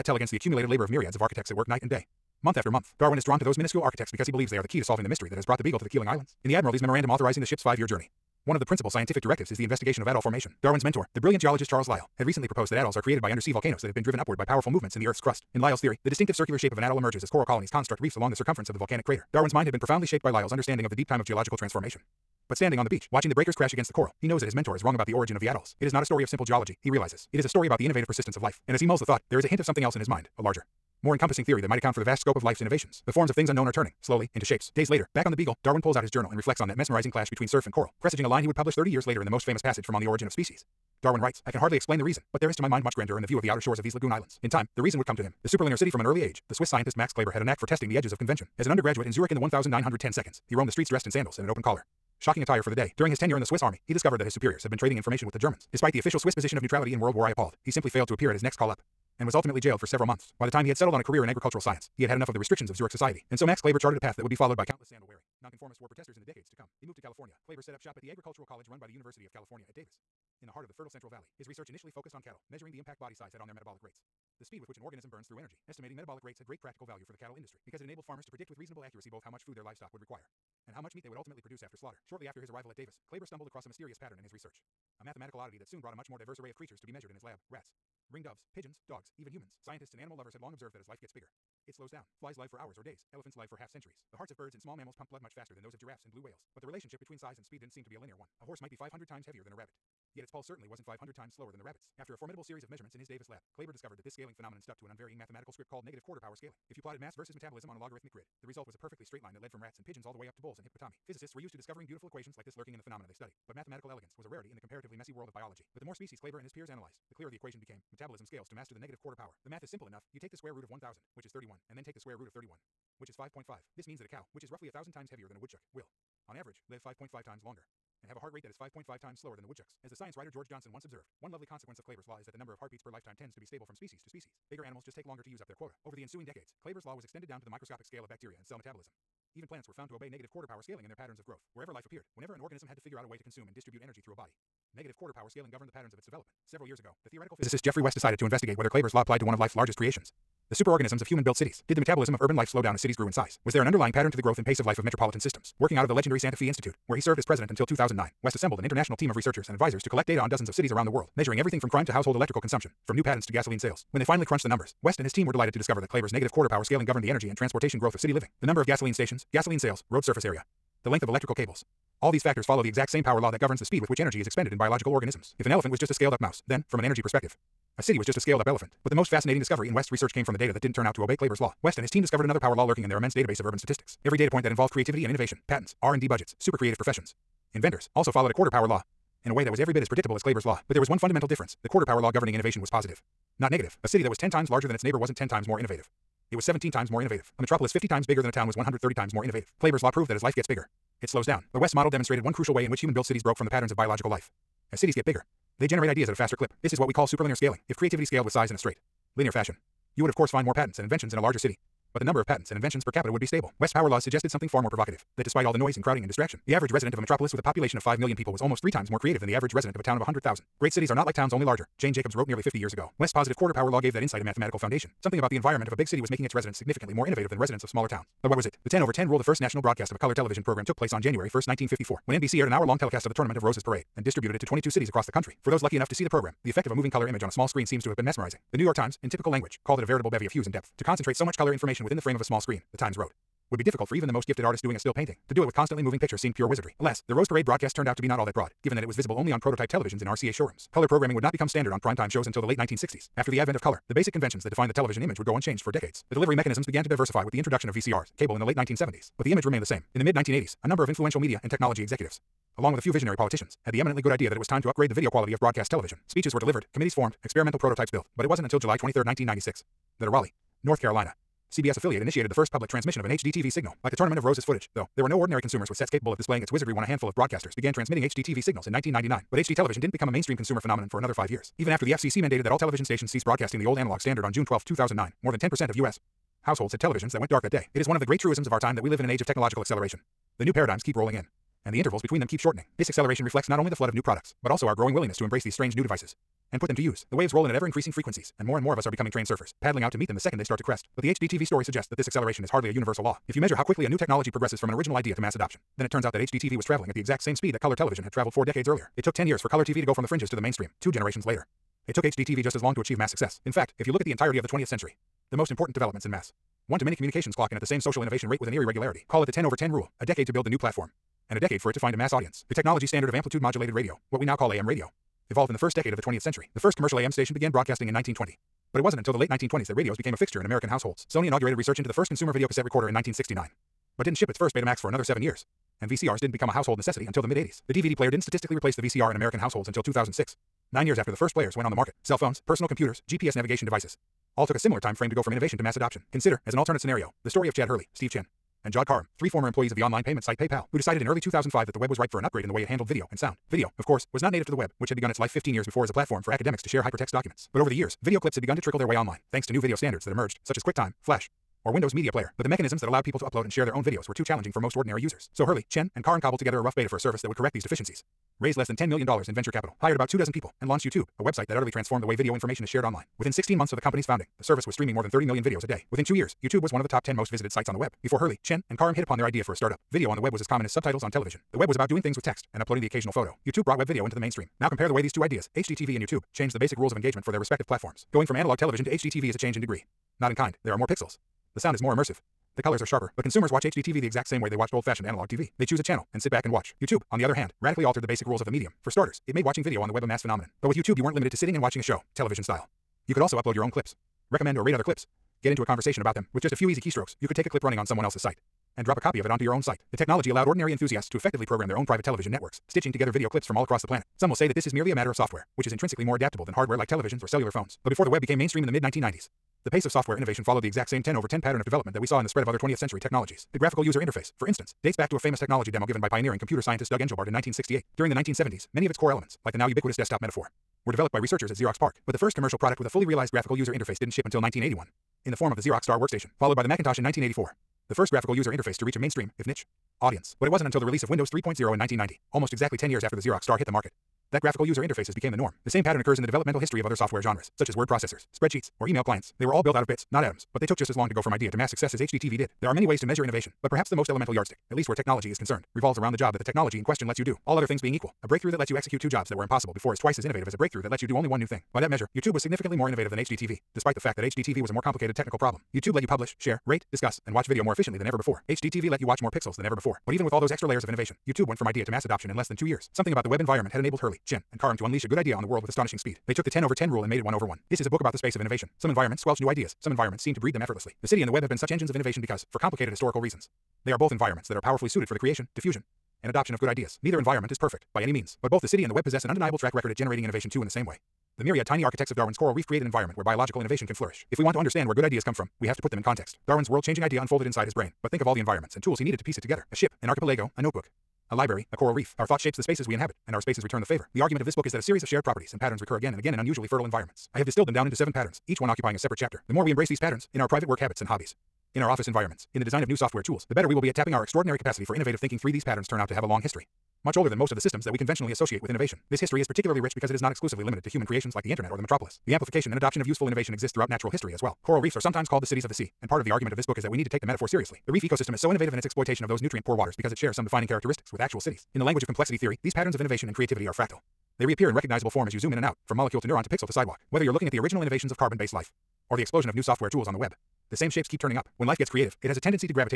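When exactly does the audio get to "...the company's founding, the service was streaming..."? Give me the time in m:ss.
6:13.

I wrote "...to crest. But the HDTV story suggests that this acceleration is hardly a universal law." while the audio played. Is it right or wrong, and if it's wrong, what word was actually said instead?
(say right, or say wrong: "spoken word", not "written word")
right.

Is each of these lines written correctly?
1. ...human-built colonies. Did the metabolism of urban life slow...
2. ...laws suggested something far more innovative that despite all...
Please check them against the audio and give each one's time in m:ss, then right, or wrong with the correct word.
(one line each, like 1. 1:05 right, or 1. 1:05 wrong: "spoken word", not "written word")
1. 2:31 wrong: "cities", not "colonies"
2. 3:33 wrong: "provocative", not "innovative".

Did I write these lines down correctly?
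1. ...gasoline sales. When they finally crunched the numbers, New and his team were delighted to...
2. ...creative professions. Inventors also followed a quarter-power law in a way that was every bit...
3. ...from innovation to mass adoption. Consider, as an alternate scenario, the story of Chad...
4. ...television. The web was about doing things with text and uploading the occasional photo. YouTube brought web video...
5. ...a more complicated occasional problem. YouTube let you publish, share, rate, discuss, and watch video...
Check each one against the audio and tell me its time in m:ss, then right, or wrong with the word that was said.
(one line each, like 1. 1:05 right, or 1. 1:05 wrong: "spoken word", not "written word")
1. 2:43 wrong: "West", not "New"
2. 3:06 right
3. 5:45 right
4. 6:21 right
5. 7:44 wrong: "technical", not "occasional".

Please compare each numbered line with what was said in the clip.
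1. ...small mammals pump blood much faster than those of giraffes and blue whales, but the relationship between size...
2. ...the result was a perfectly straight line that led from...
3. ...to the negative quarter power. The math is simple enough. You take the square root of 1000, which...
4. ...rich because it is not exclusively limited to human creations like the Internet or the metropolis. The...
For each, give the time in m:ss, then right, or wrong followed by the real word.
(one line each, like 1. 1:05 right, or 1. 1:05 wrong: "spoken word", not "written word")
1. 1:34 right
2. 1:48 right
3. 1:58 right
4. 8:39 right.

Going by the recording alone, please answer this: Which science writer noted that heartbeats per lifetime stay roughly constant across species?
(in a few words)
George Johnson.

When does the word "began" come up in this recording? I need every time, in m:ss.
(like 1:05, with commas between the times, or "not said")
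4:16, 4:37, 5:27.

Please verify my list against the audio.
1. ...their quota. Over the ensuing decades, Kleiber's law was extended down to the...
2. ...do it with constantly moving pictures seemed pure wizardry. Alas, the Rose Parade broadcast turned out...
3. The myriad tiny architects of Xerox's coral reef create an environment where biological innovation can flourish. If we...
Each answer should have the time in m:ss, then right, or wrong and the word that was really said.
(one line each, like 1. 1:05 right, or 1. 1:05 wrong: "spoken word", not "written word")
1. 2:15 right
2. 4:05 right
3. 8:11 wrong: "Darwin", not "Xerox".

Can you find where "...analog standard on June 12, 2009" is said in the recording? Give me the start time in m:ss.
4:43.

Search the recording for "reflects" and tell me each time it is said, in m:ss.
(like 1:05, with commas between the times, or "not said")
0:36, 4:53.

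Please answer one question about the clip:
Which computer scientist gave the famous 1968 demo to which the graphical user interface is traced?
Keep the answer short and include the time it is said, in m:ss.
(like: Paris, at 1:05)
Doug Engelbart, at 7:06.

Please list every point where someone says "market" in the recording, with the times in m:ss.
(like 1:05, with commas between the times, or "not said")
5:41, 7:23.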